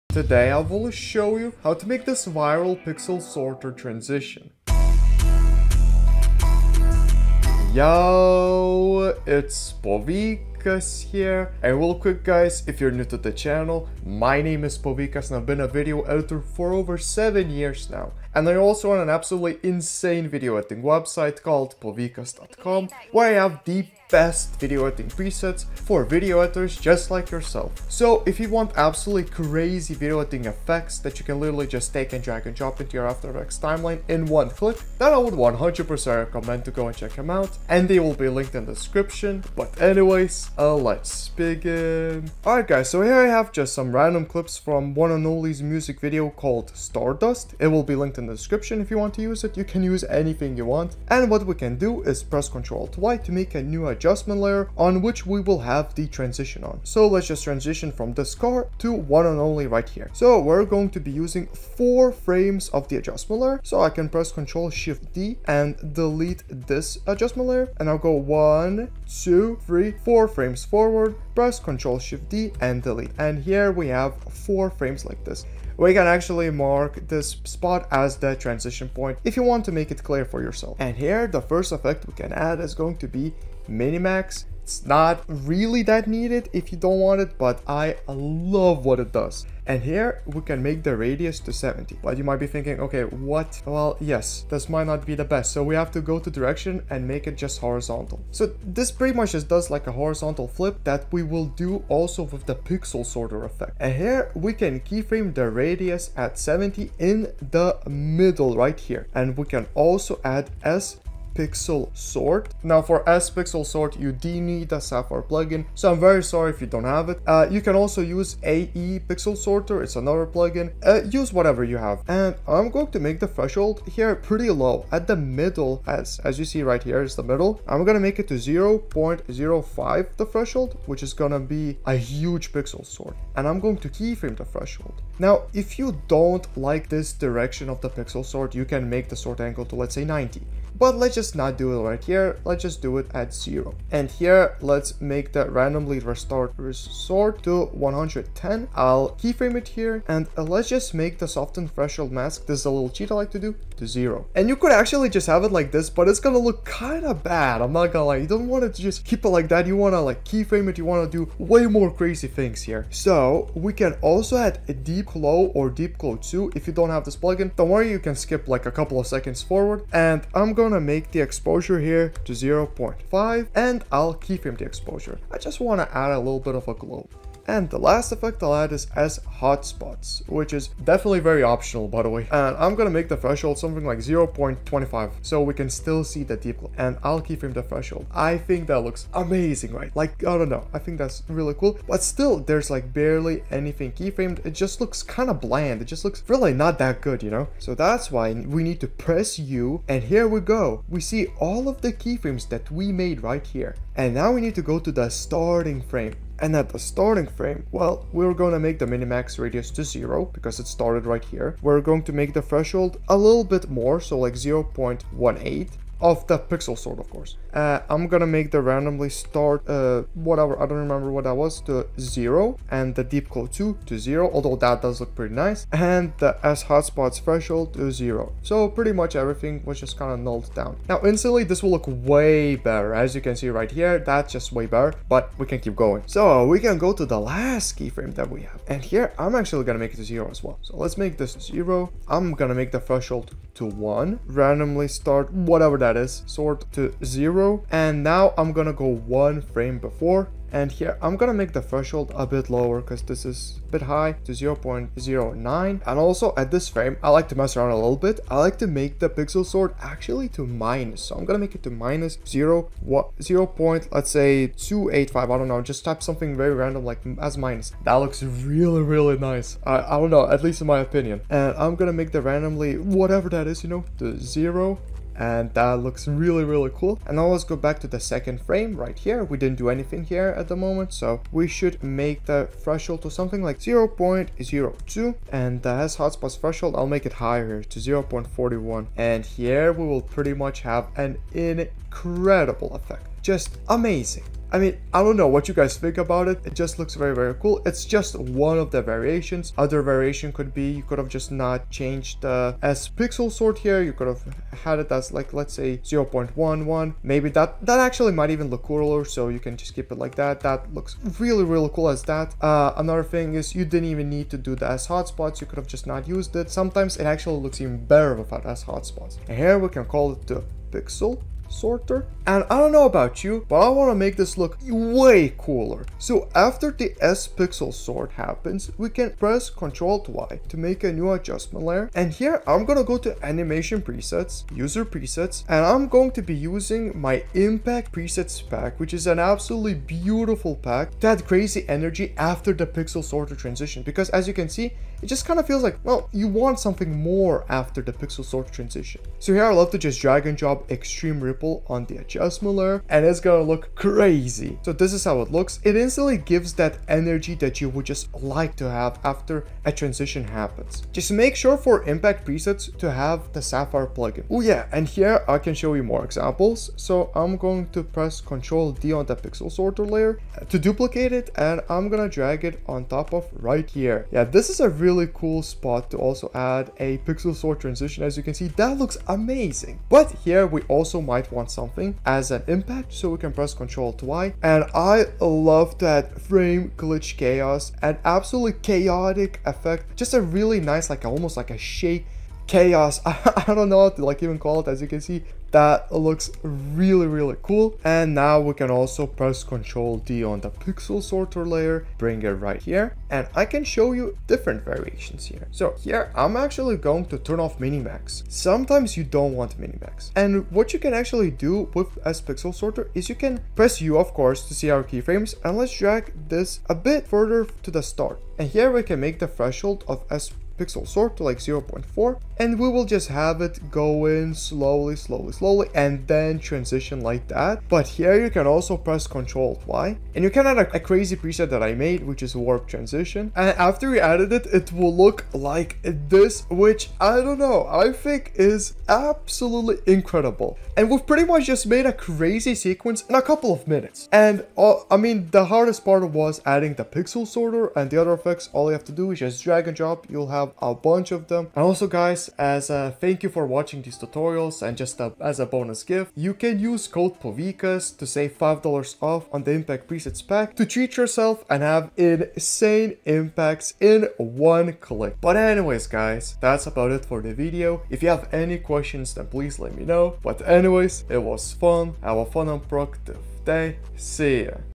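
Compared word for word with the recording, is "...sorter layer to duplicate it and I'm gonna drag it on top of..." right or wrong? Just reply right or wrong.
right.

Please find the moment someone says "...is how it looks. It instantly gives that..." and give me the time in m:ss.
5:54.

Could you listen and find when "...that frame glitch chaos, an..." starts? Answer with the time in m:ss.
6:25.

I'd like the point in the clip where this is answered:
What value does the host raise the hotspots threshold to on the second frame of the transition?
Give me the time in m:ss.
4:47.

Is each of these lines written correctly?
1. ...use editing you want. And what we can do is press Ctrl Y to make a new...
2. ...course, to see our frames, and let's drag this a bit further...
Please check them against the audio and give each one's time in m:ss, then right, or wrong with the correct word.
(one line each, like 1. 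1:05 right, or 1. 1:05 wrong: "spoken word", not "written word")
1. 0:49 wrong: "anything", not "editing"
2. 6:54 wrong: "keyframes", not "frames".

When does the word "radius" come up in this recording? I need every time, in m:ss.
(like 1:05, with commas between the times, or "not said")
1:30, 1:45, 3:29.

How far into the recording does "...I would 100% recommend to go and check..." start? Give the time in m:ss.
0:35.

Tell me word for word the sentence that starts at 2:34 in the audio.
And you could actually just have it like this, but it's gonna look kinda bad, I'm not gonna lie.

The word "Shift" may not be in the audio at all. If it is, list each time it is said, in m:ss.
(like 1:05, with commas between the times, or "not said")
1:04, 1:12.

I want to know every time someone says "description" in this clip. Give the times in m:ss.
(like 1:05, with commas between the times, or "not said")
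0:38, 0:48.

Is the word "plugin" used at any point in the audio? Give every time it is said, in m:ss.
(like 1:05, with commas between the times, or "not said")
1:55, 2:00, 2:47, 6:03.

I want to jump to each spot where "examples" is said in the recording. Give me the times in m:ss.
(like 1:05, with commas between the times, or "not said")
6:06.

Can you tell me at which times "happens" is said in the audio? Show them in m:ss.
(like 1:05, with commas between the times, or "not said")
5:28, 6:00.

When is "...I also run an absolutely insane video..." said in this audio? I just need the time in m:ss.
0:18.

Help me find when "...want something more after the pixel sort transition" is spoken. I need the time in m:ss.
5:46.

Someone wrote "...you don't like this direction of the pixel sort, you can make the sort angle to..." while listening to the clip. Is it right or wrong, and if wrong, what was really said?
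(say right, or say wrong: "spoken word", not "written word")
right.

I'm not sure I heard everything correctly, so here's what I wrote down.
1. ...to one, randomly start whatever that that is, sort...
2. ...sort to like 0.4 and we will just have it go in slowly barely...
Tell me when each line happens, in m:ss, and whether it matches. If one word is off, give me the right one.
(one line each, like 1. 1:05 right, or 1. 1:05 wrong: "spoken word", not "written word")
1. 4:03 right
2. 7:00 wrong: "slowly", not "barely".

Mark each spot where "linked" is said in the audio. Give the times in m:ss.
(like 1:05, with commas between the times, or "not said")
0:38, 0:47.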